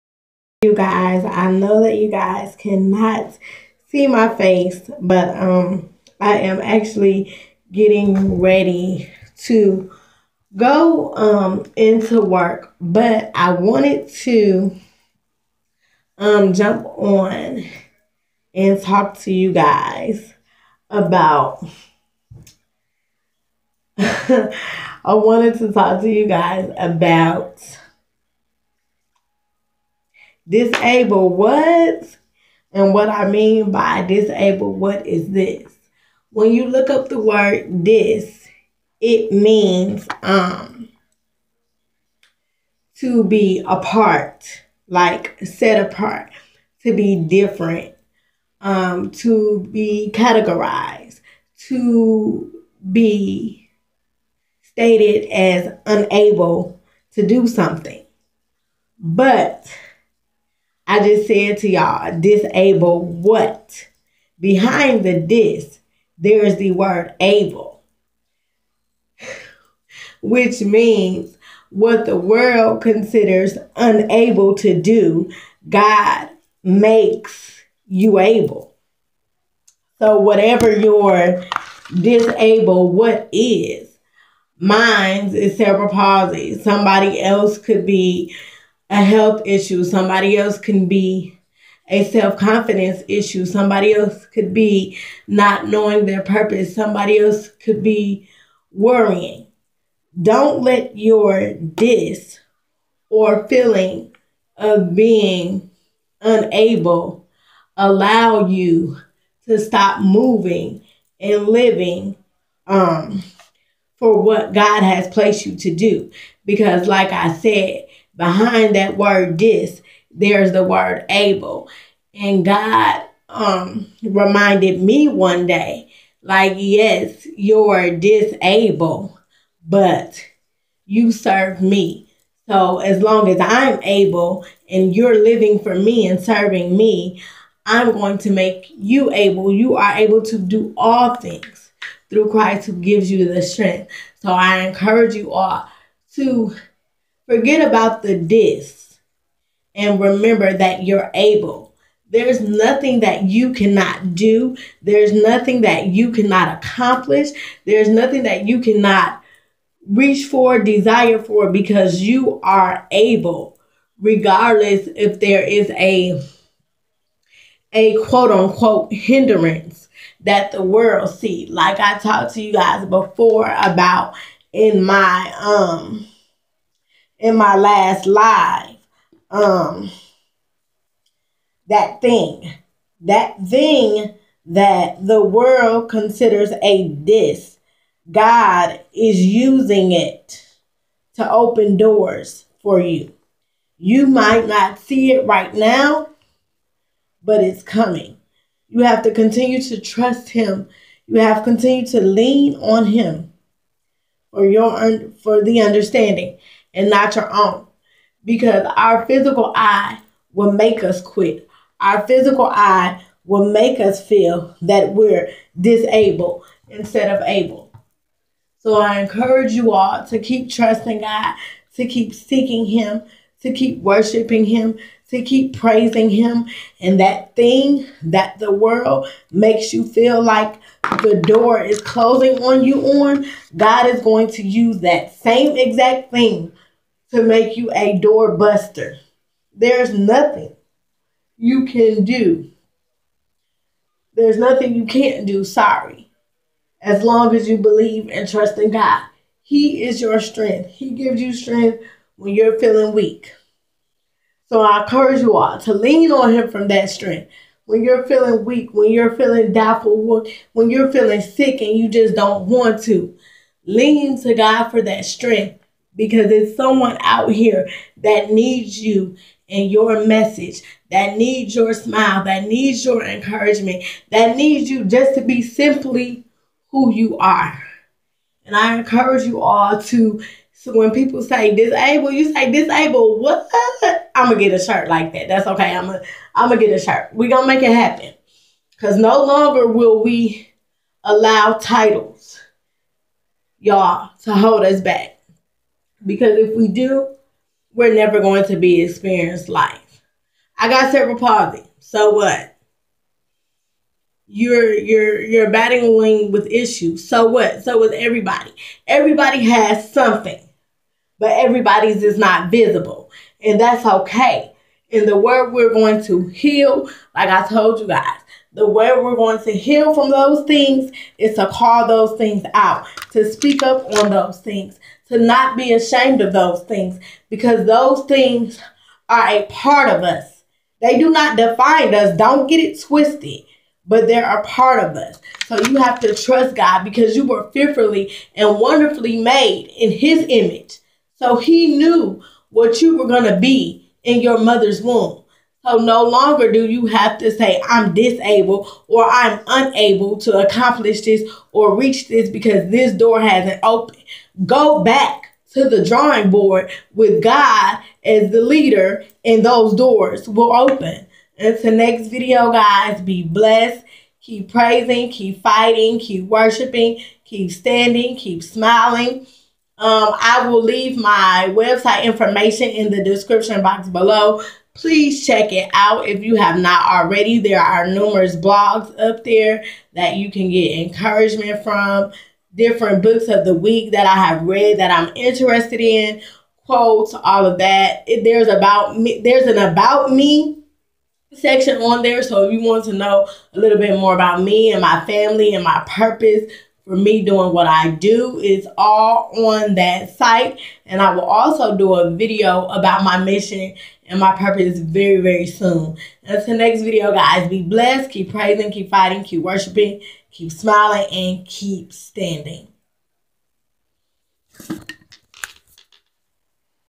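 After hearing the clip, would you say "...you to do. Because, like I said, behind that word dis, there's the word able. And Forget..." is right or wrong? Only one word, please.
wrong.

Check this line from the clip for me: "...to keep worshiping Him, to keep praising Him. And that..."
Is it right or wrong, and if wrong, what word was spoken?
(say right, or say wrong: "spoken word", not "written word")
right.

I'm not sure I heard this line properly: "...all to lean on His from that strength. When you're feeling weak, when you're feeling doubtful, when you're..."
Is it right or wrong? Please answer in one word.
wrong.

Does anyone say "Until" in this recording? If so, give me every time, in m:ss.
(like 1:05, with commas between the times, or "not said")
6:01, 6:46.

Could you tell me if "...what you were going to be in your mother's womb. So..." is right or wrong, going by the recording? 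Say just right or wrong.
right.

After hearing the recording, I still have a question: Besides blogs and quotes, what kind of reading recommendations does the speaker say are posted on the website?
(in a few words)
books of the week.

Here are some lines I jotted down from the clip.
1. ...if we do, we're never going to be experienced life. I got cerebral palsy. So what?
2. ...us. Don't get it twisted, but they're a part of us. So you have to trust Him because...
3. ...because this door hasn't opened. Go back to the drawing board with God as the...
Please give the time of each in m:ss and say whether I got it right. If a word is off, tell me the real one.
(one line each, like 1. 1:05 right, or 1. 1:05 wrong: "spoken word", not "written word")
1. 4:56 right
2. 5:31 wrong: "God", not "Him"
3. 5:52 right.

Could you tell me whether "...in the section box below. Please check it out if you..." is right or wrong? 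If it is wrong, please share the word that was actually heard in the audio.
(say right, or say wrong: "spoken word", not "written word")
wrong: "description", not "section".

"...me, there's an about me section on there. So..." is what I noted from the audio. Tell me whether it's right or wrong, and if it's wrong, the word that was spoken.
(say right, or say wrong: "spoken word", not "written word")
right.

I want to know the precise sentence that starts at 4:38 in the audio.
And I encourage you all to so when people say disabled, you say disabled.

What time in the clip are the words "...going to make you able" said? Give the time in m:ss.
2:17.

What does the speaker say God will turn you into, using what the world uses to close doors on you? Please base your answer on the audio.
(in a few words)
door buster.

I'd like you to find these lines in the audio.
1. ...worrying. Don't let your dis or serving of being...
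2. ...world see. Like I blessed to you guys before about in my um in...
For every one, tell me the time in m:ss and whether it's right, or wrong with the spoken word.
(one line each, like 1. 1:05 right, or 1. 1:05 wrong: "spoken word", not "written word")
1. 1:38 wrong: "feeling", not "serving"
2. 2:50 wrong: "talked", not "blessed".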